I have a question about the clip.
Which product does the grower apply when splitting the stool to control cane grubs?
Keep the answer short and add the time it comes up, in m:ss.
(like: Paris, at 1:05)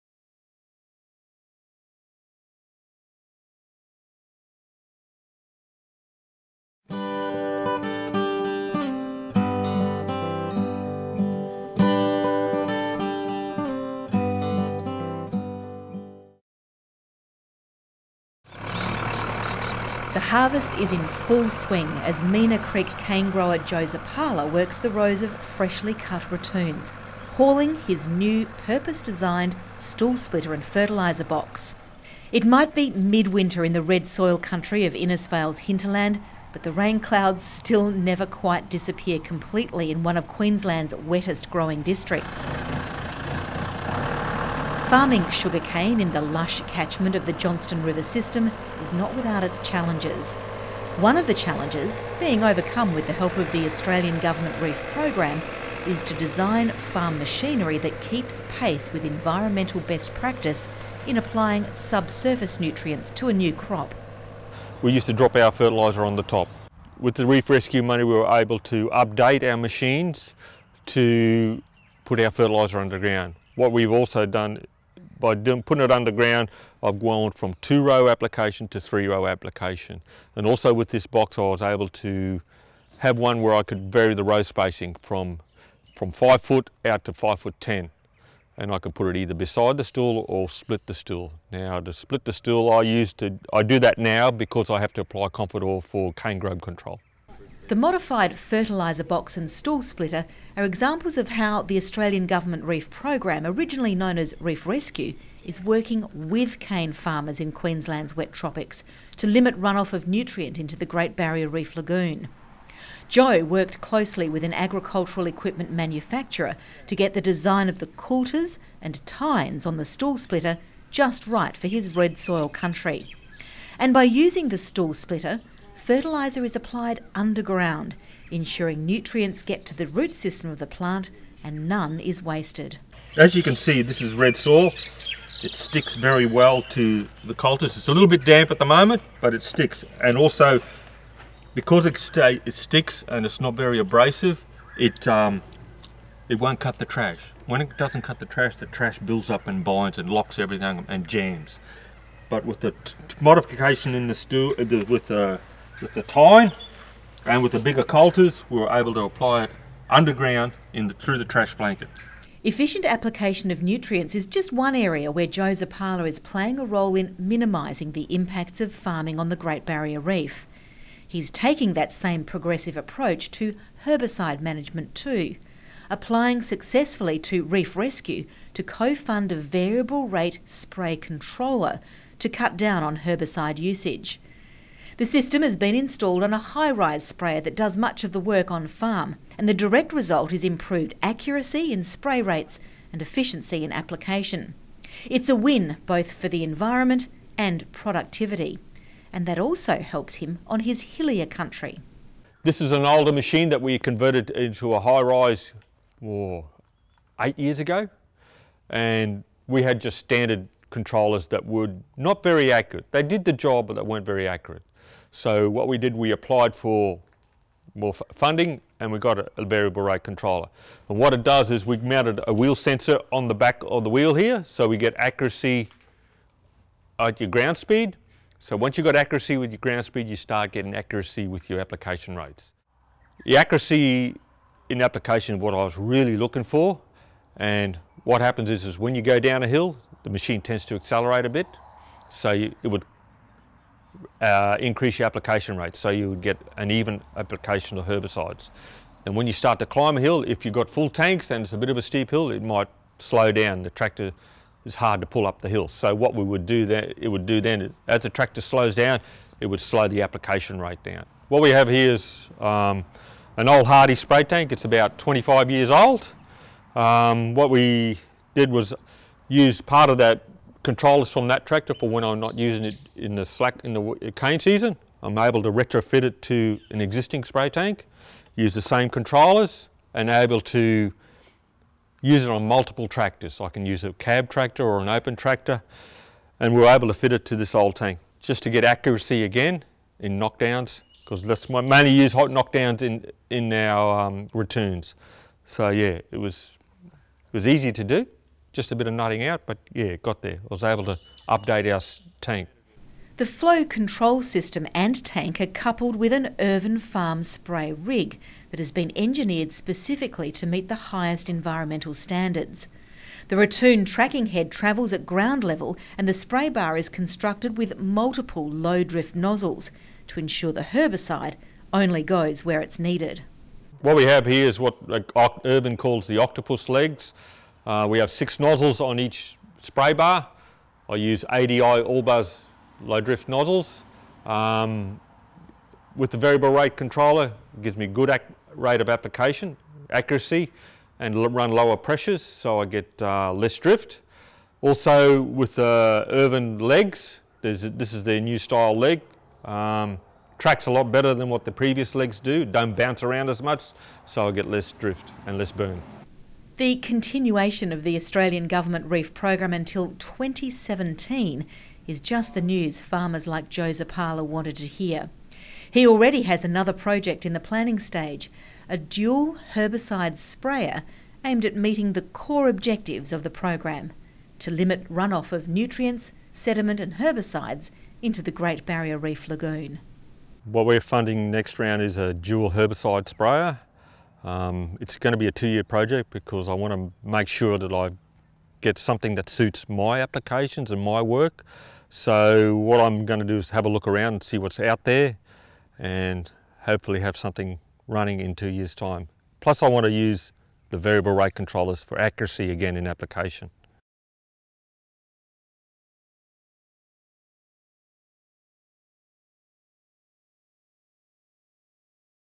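Confidor, at 1:35.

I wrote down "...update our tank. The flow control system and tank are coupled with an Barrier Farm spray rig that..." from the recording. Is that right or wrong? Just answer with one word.
wrong.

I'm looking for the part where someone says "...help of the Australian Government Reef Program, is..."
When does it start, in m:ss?
0:53.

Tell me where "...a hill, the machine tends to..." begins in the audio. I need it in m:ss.
3:59.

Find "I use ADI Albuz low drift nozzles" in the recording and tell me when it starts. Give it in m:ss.
5:30.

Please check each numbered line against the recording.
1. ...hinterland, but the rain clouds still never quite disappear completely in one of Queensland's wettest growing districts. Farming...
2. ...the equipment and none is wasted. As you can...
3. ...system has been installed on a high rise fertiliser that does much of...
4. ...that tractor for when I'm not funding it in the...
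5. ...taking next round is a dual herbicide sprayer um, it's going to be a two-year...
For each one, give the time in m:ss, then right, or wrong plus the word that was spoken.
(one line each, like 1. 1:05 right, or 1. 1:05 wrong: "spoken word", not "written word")
1. 0:35 right
2. 2:10 wrong: "plant", not "equipment"
3. 3:05 wrong: "sprayer", not "fertiliser"
4. 4:31 wrong: "using", not "funding"
5. 6:20 wrong: "funding", not "taking".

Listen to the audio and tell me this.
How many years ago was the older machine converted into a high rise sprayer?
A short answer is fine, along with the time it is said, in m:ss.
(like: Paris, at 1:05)
8, at 3:27.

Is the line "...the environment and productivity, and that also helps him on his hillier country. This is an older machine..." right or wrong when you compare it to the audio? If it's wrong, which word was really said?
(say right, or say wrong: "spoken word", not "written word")
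right.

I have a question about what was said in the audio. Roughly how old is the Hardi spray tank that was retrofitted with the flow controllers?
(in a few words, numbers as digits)
25 years.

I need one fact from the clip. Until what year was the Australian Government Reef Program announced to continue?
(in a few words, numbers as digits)
2017.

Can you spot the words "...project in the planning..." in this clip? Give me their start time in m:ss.
6:06.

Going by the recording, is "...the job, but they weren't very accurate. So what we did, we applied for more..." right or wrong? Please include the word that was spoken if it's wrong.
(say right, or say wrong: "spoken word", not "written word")
right.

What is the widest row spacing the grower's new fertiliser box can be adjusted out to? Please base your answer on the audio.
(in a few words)
5 foot 10.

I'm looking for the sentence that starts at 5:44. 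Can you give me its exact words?
Also with the uh, Irvin legs, this is their new style leg.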